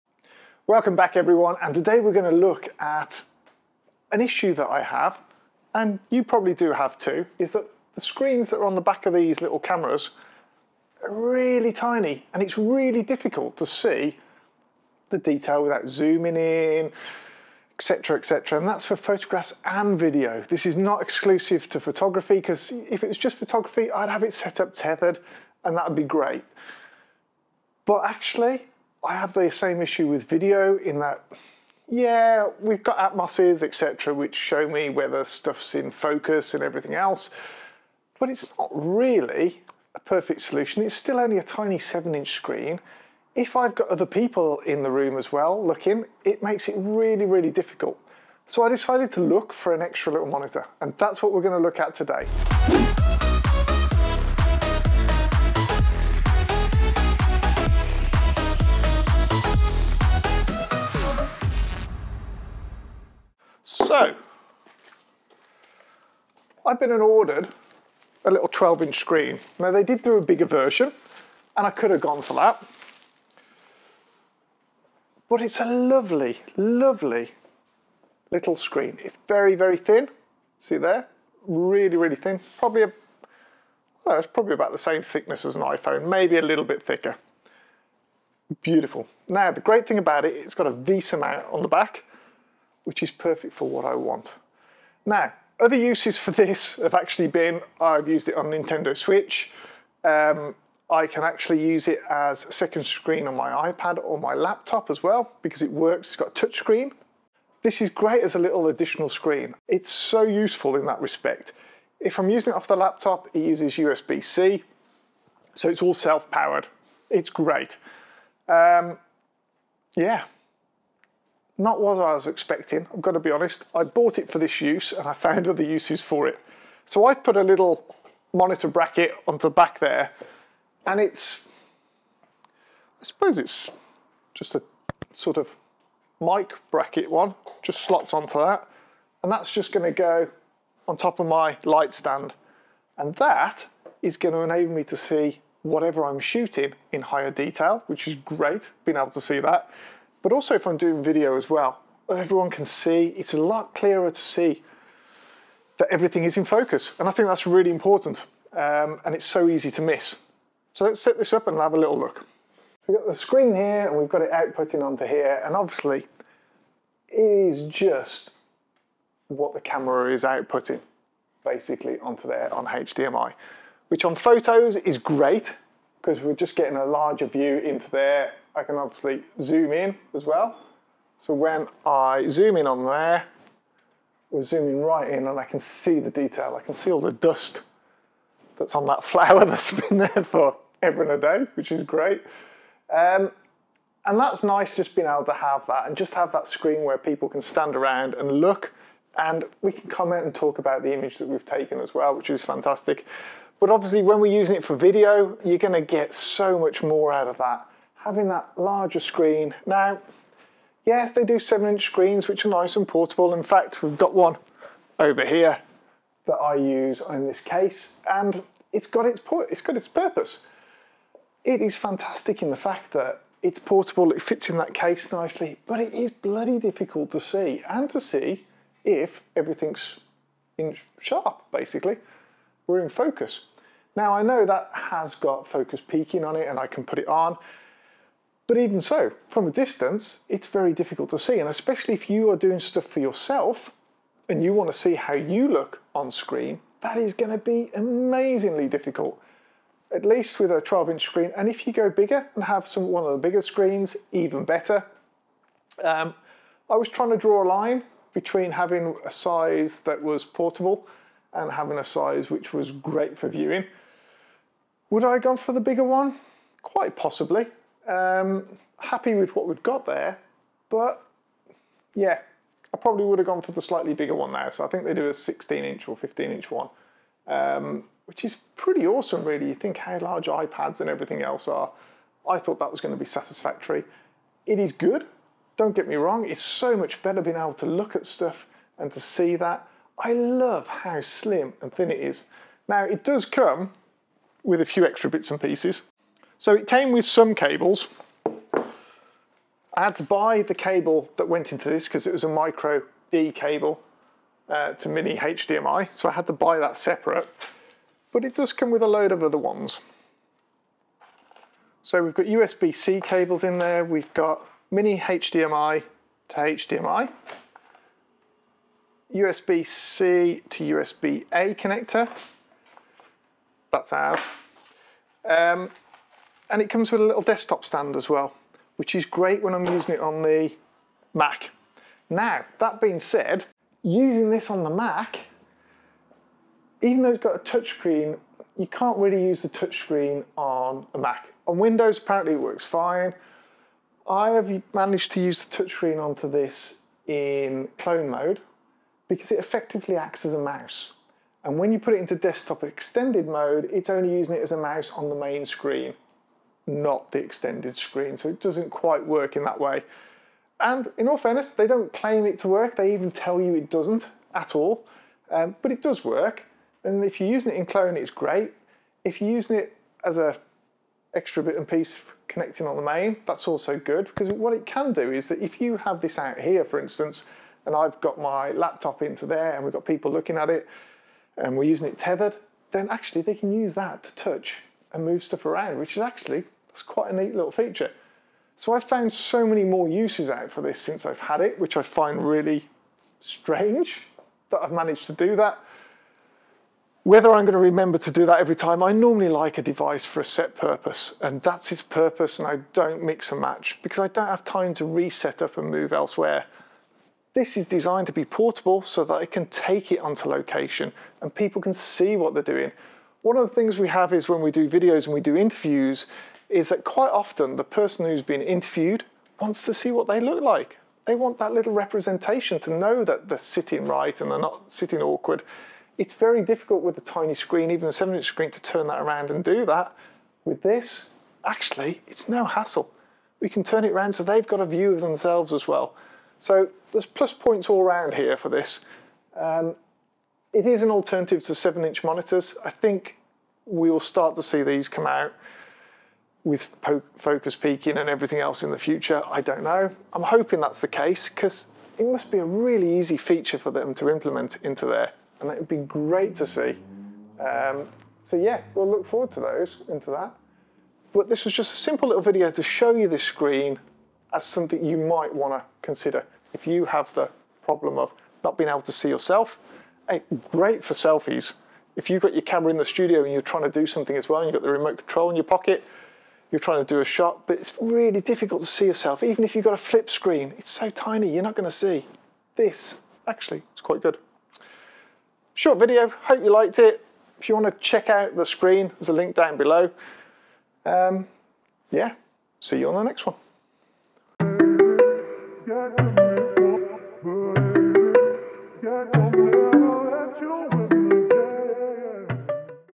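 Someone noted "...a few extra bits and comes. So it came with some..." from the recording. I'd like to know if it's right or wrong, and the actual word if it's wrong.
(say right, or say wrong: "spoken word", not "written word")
wrong: "pieces", not "comes".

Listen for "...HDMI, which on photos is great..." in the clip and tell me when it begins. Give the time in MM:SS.
02:52.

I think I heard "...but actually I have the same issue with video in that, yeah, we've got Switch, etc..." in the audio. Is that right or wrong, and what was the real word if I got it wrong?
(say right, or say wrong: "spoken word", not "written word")
wrong: "Atomoses", not "Switch".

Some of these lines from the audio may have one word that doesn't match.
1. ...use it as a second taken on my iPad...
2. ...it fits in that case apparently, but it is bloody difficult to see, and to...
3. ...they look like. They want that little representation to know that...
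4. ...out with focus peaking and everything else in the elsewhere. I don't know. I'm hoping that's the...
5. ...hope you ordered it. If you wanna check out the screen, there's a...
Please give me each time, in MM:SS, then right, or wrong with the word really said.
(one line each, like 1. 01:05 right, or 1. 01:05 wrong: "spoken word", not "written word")
1. 01:41 wrong: "screen", not "taken"
2. 03:44 wrong: "nicely", not "apparently"
3. 07:00 right
4. 07:25 wrong: "future", not "elsewhere"
5. 08:06 wrong: "liked", not "ordered".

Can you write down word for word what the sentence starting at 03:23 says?
But obviously when we're using it for video, you're gonna get so much more out of that having that larger screen.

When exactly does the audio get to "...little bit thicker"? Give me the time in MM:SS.
01:26.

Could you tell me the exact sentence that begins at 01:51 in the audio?
If I'm using it off the laptop, it uses USB-C, so it's all self-powered.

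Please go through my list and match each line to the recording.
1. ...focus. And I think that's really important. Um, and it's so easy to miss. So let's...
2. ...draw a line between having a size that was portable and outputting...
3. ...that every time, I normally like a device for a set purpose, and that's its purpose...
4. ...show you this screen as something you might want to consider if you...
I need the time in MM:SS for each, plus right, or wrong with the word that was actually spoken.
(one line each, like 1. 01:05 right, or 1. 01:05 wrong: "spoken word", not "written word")
1. 02:36 right
2. 04:17 wrong: "having", not "outputting"
3. 06:38 right
4. 07:42 right.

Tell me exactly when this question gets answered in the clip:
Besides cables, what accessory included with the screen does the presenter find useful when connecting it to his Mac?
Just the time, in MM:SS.
05:27.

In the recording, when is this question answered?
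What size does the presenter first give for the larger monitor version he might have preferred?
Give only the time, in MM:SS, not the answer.
04:35.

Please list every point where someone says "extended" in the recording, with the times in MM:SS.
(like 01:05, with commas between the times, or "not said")
05:52, 05:57.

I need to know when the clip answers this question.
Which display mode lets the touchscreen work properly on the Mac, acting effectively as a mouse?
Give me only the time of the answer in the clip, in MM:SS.
05:47.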